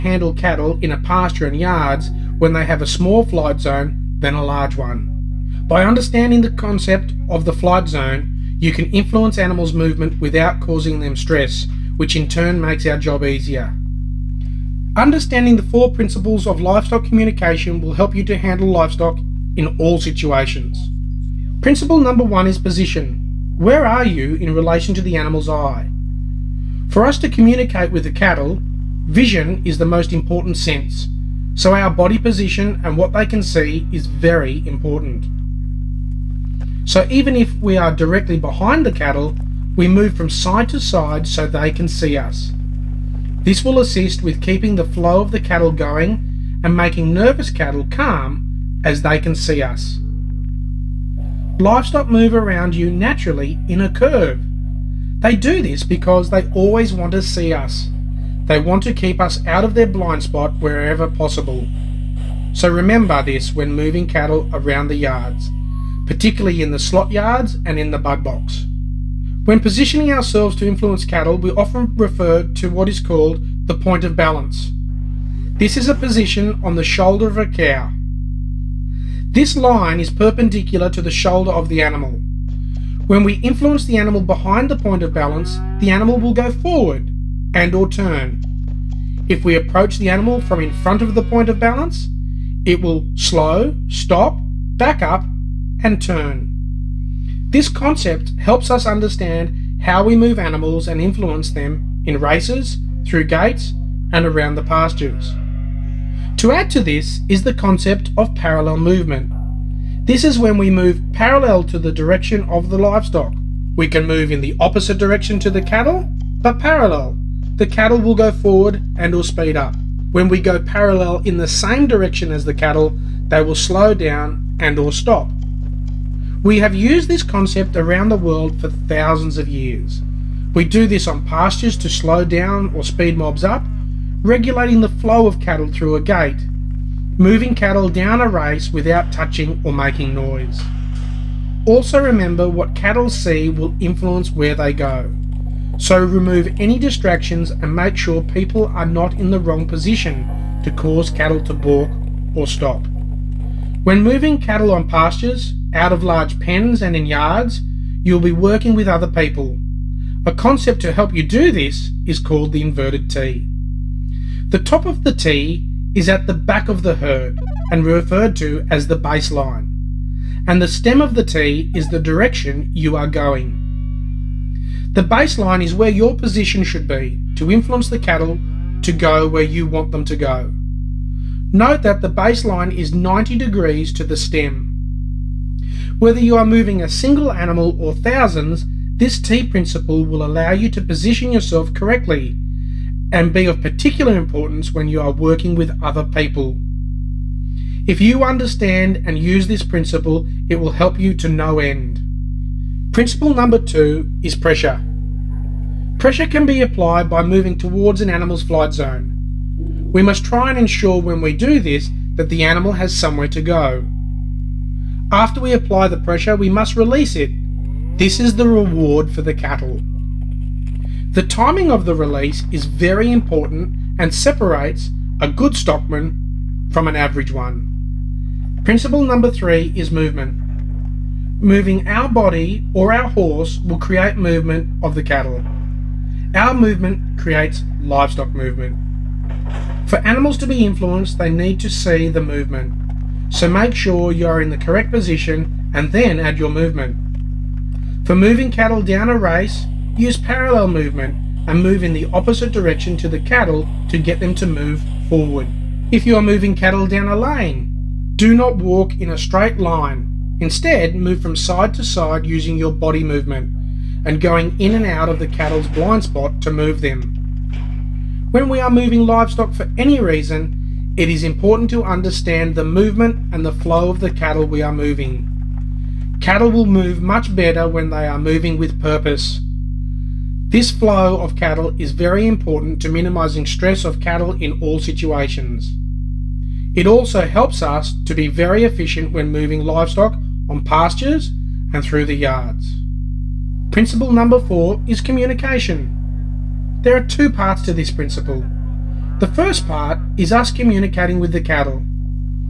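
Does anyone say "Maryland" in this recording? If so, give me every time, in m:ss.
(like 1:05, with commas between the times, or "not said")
not said.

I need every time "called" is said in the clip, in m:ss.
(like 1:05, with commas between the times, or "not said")
1:12, 2:42.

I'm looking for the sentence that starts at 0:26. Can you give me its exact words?
For us to communicate with the cattle, vision is the most important sense.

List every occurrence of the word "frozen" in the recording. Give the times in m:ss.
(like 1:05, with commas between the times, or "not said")
not said.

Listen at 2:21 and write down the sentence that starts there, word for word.
Also remember what cattle see will influence where they go.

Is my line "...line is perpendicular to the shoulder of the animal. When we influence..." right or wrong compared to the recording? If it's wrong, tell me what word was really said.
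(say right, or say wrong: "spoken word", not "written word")
right.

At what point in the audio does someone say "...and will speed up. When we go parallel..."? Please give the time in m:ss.
1:58.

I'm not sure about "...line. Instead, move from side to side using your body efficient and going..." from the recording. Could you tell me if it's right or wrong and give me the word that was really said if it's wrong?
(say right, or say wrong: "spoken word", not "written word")
wrong: "movement", not "efficient".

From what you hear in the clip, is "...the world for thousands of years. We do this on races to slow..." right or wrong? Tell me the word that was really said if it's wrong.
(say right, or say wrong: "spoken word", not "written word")
wrong: "pastures", not "races".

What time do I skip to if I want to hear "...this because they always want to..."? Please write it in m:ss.
0:55.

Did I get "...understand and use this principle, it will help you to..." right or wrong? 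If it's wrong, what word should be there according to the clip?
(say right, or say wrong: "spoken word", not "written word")
right.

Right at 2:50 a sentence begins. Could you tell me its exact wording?
And the stem of the T is the direction you are going.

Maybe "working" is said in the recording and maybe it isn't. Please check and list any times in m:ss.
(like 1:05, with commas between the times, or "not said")
2:38, 3:15.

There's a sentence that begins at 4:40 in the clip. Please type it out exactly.
This flow of cattle is very important to minimizing stress of cattle in all situations.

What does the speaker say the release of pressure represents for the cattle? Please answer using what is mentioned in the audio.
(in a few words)
The reward.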